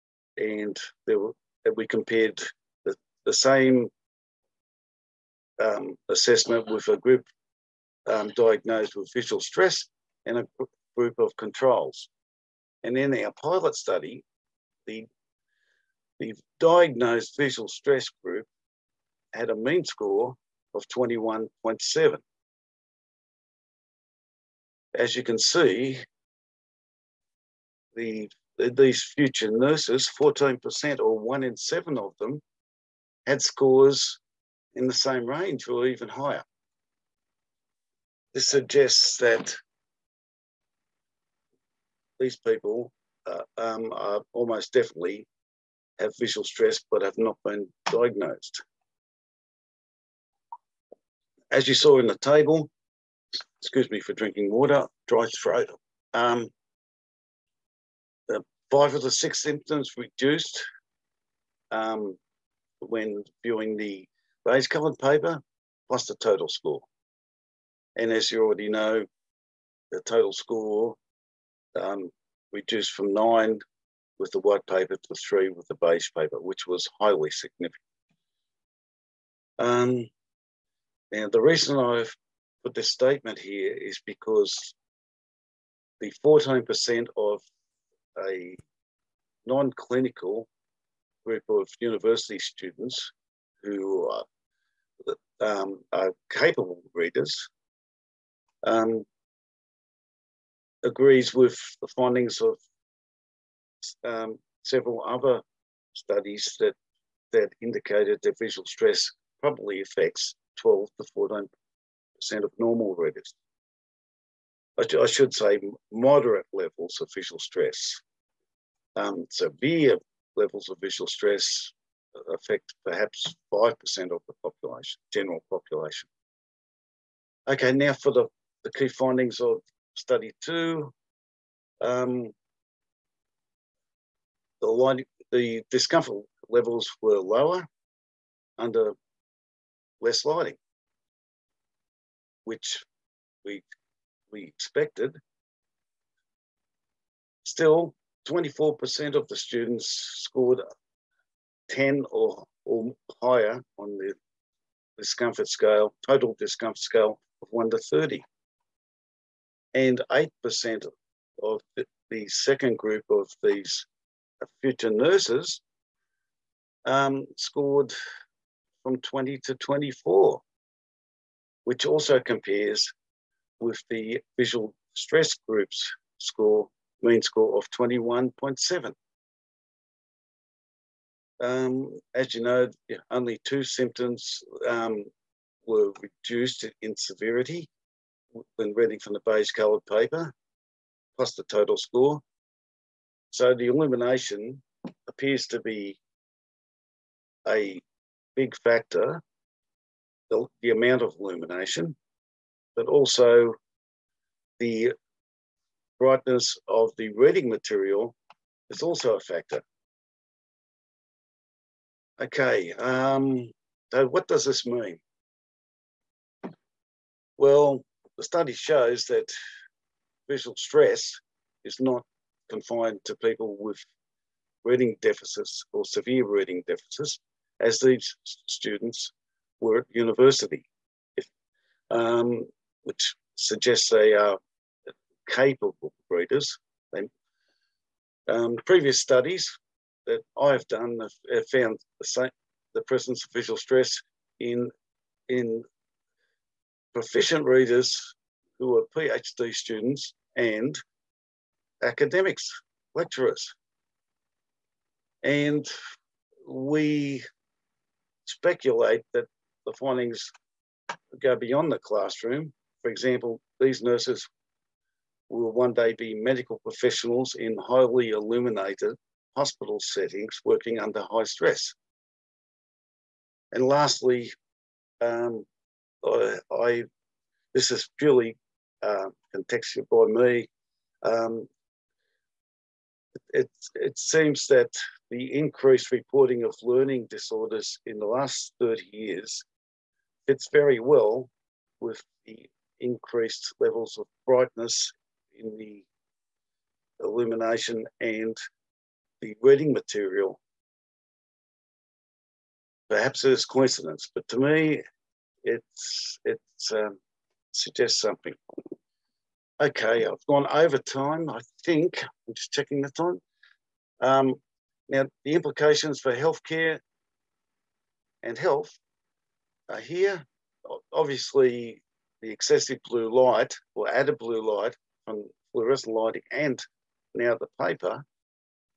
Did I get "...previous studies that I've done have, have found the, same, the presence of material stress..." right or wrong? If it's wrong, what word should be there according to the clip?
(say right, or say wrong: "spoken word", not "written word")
wrong: "visual", not "material".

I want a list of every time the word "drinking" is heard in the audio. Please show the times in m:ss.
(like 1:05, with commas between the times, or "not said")
0:54.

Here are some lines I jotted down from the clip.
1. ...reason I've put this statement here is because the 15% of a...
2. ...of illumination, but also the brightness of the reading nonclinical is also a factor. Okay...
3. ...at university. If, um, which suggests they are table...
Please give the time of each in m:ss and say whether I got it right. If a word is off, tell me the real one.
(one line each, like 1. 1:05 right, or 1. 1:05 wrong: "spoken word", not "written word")
1. 1:21 wrong: "14", not "15"
2. 3:21 wrong: "material", not "nonclinical"
3. 3:49 wrong: "capable", not "table".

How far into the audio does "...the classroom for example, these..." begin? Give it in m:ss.
4:21.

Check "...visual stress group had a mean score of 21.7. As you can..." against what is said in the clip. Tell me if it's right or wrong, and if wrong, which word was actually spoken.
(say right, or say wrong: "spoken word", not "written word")
right.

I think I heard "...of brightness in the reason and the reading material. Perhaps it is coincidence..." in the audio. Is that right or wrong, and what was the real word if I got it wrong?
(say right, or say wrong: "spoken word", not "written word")
wrong: "illumination", not "reason".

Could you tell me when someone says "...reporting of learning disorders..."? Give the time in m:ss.
4:45.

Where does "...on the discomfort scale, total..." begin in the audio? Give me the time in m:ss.
2:33.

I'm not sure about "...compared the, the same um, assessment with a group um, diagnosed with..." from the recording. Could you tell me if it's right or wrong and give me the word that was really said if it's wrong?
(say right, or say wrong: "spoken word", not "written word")
right.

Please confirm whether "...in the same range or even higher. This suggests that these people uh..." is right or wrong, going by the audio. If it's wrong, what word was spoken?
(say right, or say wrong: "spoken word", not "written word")
right.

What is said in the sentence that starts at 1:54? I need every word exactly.
I, should say, moderate levels of visual stress.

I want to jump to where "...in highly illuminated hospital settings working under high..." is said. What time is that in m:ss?
4:27.